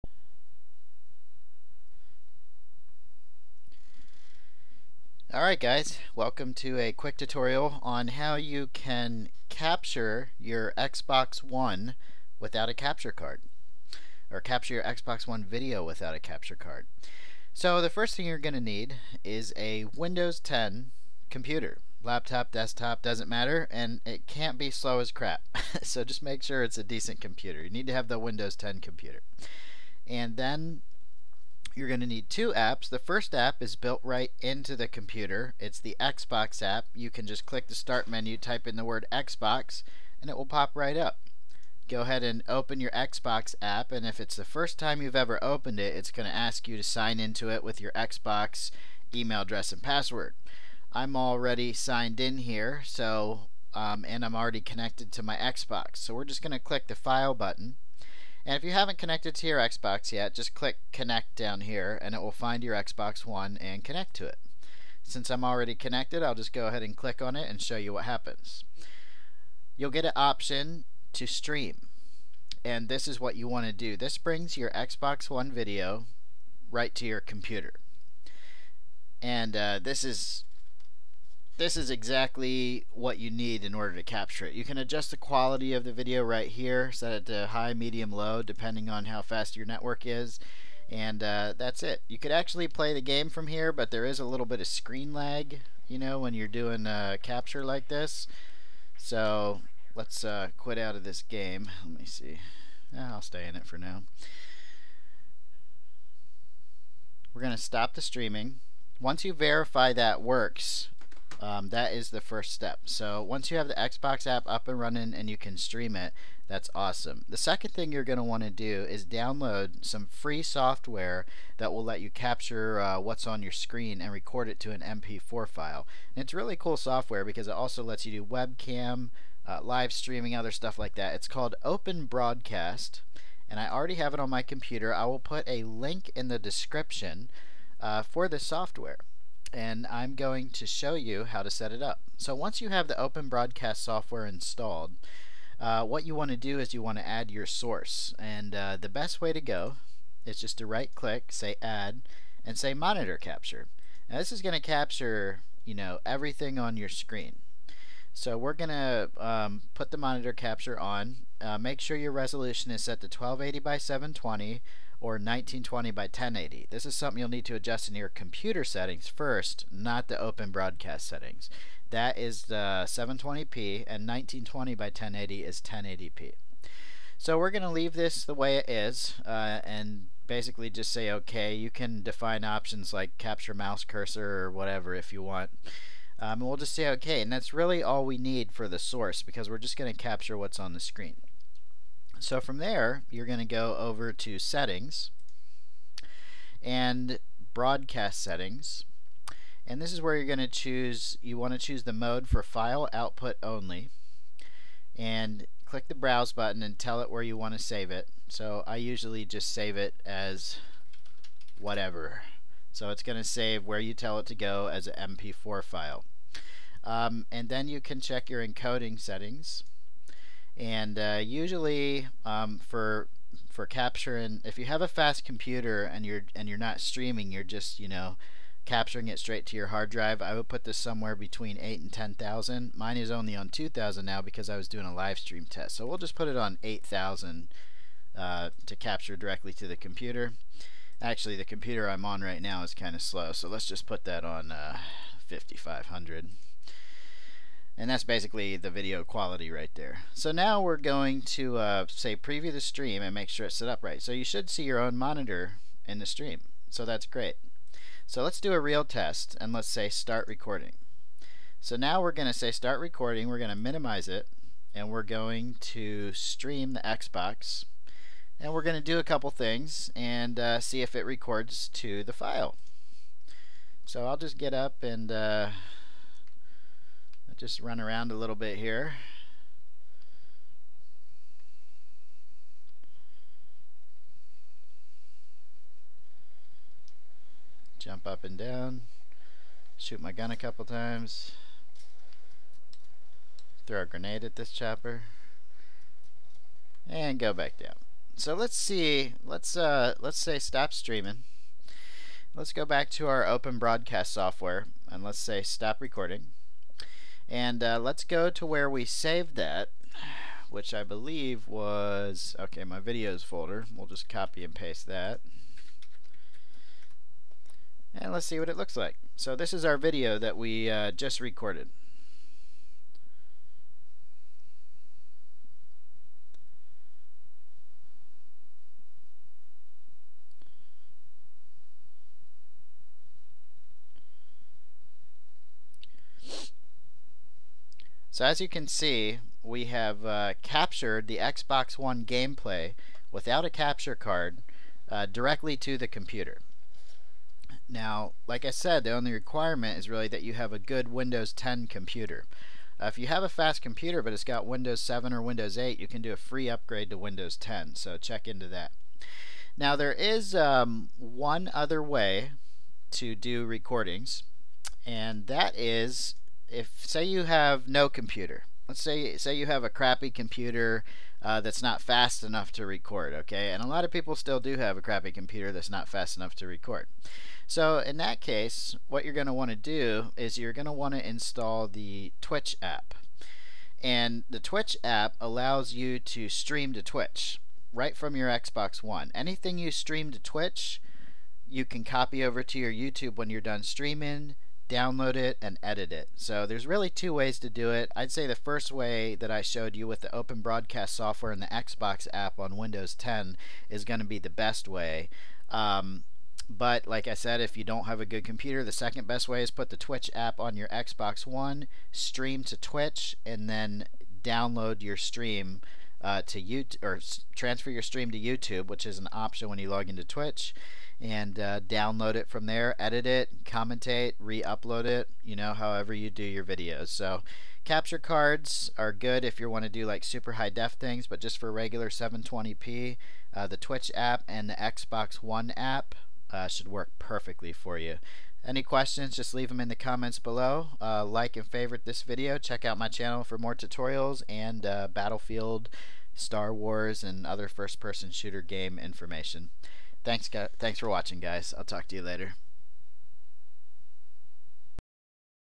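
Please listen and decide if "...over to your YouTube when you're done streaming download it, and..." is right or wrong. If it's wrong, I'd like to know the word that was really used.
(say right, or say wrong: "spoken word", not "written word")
right.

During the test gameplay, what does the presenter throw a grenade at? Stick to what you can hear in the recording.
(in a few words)
chopper.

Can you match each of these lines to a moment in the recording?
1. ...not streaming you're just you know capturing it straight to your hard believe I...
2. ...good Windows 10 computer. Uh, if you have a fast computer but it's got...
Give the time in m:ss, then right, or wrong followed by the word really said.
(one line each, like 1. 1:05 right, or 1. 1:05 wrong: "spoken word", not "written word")
1. 3:46 wrong: "drive", not "believe"
2. 5:50 right.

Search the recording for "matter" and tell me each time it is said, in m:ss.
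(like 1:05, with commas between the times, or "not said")
0:23.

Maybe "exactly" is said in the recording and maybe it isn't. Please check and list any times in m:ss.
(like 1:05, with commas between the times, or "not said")
1:21.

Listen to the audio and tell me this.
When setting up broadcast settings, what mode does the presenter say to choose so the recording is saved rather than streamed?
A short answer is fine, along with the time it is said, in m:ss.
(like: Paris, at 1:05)
file output only, at 3:22.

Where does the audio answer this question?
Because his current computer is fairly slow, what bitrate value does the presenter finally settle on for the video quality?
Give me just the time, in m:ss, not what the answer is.
4:05.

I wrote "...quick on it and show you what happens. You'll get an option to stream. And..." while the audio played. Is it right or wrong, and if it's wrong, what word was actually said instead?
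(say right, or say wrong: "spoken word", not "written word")
wrong: "click", not "quick".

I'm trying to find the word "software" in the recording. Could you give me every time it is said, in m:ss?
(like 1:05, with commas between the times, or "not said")
2:00, 2:06, 2:18, 2:23, 5:04, 6:40.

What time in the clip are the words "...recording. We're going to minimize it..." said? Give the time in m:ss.
4:22.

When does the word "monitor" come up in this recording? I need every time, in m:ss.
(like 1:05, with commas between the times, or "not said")
2:32, 2:39, 4:14.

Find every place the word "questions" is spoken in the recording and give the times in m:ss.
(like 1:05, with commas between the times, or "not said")
7:18.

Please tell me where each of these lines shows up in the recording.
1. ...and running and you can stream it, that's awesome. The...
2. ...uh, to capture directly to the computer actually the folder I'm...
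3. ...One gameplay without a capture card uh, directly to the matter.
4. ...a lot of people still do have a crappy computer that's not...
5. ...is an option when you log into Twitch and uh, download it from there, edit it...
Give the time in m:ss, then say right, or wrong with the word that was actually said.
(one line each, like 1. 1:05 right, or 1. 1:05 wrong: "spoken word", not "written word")
1. 1:54 right
2. 3:58 wrong: "computer", not "folder"
3. 5:41 wrong: "computer", not "matter"
4. 6:13 right
5. 6:58 right.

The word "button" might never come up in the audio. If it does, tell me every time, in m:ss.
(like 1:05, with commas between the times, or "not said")
0:57, 3:26.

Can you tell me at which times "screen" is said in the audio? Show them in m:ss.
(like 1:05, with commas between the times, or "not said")
1:34, 2:03, 2:36, 3:10.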